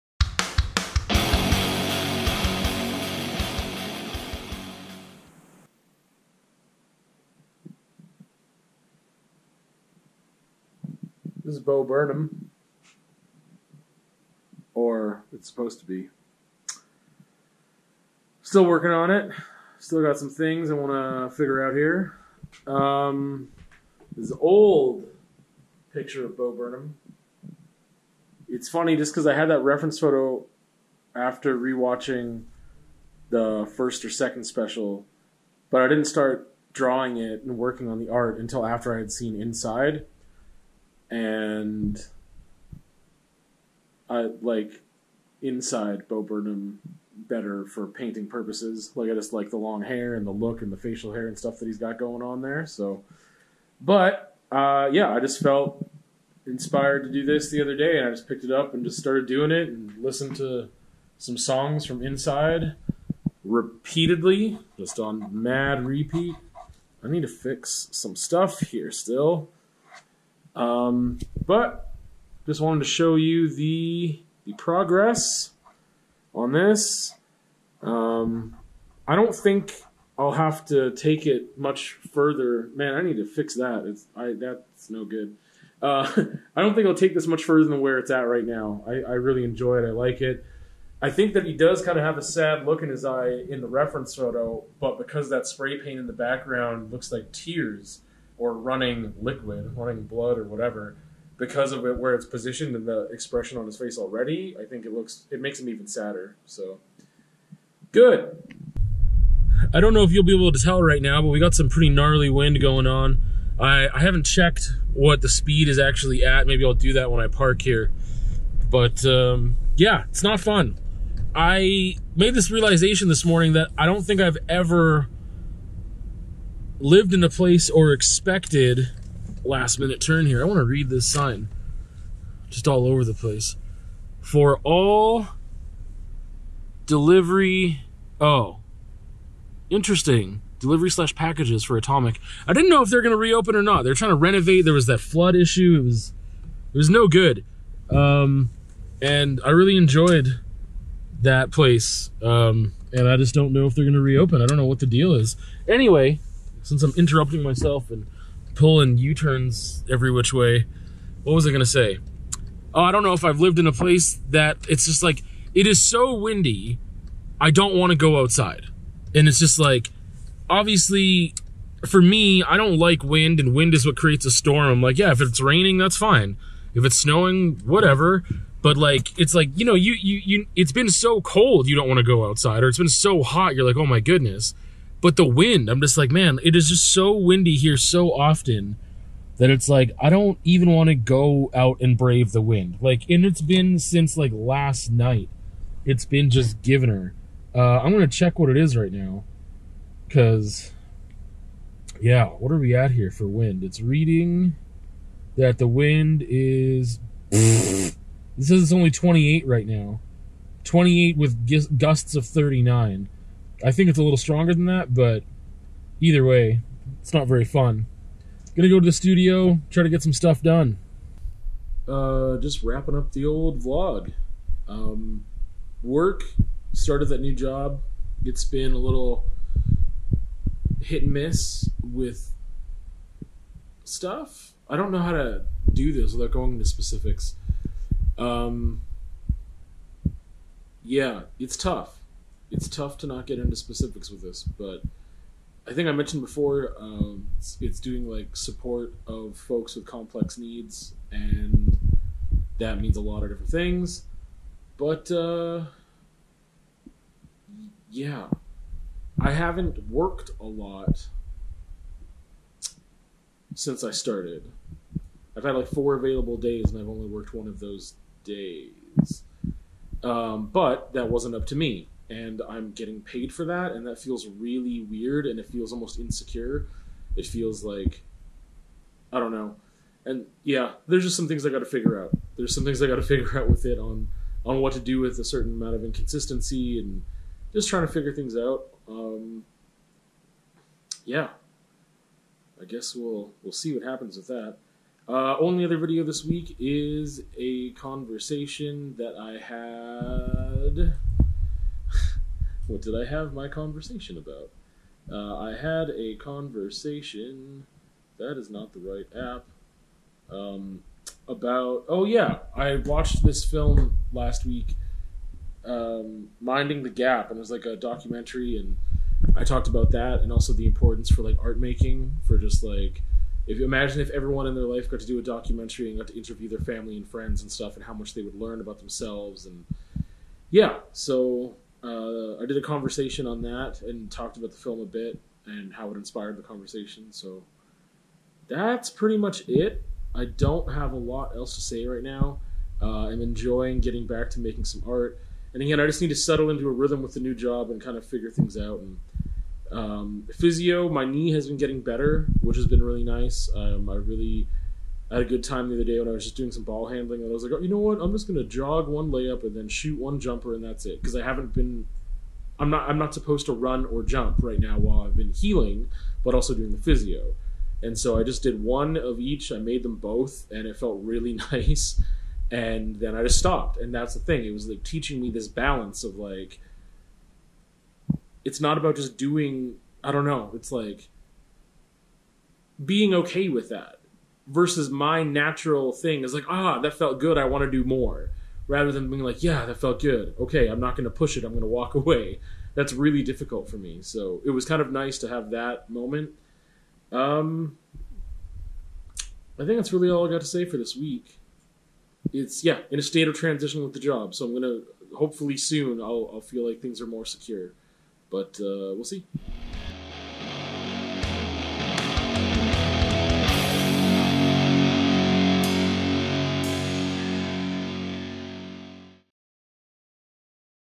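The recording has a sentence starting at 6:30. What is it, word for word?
Okay, I'm not going to push it.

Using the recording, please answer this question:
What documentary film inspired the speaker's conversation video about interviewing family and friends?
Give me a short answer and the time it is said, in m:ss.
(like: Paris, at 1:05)
Minding the Gap, at 5:16.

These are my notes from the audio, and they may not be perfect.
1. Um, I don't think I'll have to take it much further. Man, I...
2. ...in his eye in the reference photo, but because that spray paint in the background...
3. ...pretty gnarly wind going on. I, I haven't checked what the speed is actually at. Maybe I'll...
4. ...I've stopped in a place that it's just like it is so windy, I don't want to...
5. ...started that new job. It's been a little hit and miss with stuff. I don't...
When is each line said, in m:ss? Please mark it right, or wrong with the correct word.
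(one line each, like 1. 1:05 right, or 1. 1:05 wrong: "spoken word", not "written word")
1. 1:17 right
2. 1:32 right
3. 1:51 right
4. 2:43 wrong: "lived", not "stopped"
5. 3:46 right.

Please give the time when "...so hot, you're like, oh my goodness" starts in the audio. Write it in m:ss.
3:02.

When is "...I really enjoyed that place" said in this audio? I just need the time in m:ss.
2:29.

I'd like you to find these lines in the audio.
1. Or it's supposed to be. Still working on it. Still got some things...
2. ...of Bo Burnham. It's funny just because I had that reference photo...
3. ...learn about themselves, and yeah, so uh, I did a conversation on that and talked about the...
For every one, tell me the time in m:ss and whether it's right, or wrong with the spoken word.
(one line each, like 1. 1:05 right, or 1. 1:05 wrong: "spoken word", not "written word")
1. 0:14 right
2. 0:26 right
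3. 5:28 right.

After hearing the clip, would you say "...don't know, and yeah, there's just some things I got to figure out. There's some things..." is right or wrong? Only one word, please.
right.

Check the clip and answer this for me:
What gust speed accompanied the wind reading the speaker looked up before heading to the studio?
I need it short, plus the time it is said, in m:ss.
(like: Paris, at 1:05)
39, at 3:32.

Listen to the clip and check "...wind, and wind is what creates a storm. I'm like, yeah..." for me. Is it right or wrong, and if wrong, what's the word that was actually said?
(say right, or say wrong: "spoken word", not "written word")
right.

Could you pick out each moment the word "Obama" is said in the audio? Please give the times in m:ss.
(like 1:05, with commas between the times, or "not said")
not said.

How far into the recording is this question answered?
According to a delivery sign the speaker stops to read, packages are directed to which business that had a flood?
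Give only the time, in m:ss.
2:21.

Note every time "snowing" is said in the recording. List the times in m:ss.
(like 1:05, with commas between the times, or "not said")
2:56.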